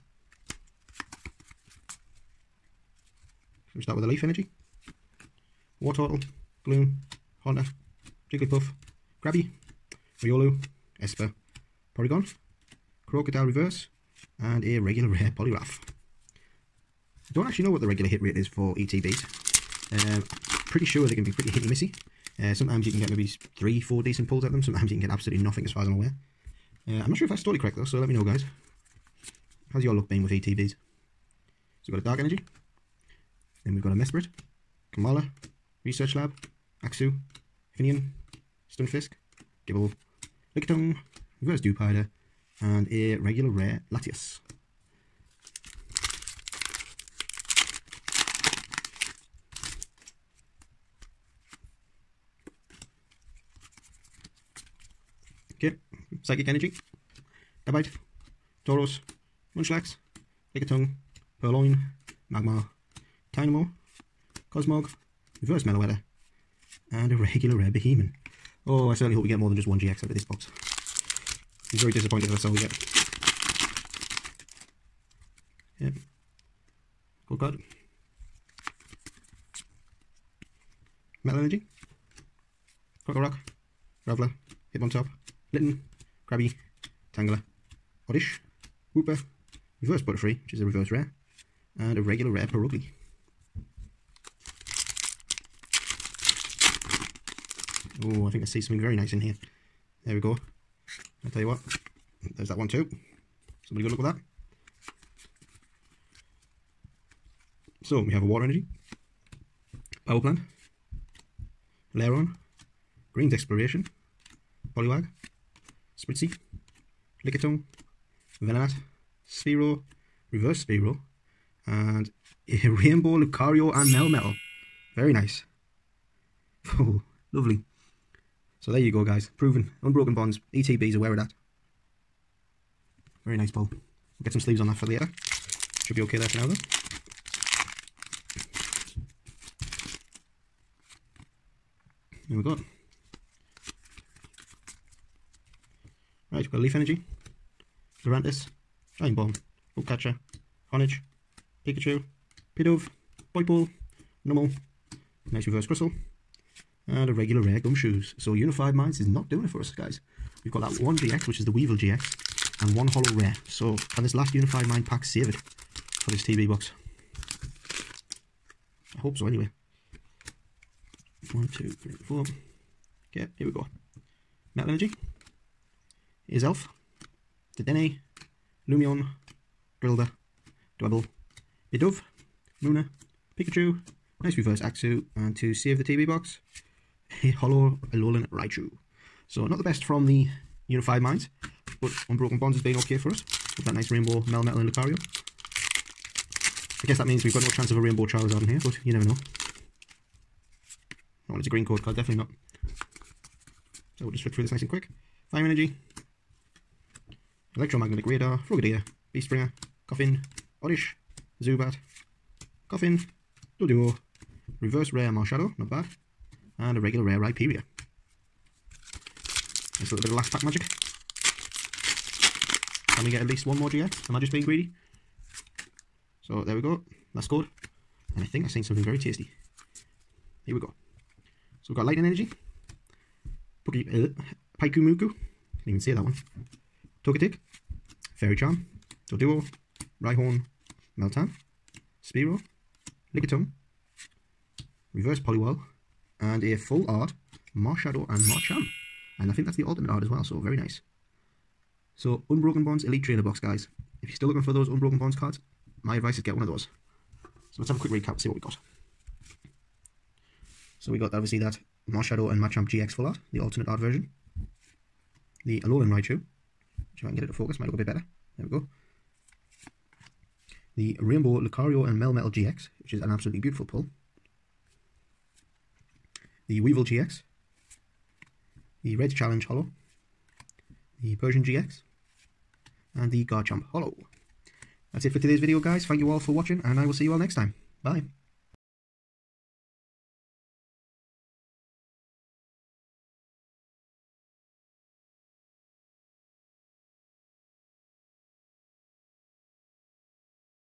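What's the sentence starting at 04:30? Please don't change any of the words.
the Rainbow Lucario and Melmetal GX, which is an absolutely beautiful pull.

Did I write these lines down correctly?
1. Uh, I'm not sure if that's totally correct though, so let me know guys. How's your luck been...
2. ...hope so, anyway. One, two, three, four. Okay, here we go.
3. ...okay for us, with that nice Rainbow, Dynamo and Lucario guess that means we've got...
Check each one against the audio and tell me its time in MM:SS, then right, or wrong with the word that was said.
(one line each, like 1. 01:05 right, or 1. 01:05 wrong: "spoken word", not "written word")
1. 00:26 right
2. 02:48 right
3. 03:12 wrong: "Melmetal", not "Dynamo".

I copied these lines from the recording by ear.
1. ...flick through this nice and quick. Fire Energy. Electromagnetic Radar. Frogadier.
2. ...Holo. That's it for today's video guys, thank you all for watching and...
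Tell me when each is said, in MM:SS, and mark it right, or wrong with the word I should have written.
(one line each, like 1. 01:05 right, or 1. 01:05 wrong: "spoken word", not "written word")
1. 03:24 right
2. 04:43 right.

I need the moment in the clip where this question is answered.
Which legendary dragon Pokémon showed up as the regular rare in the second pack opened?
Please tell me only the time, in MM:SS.
00:43.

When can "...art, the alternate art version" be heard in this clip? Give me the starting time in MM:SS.
04:23.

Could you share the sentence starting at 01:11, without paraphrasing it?
I'm very disappointed that that's all we get.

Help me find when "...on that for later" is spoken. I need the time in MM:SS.
02:14.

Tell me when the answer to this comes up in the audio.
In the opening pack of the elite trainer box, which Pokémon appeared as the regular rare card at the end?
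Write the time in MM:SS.
00:15.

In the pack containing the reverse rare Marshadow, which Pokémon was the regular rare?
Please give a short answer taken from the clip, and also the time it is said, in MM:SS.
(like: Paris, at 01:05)
Rhyperior, at 03:37.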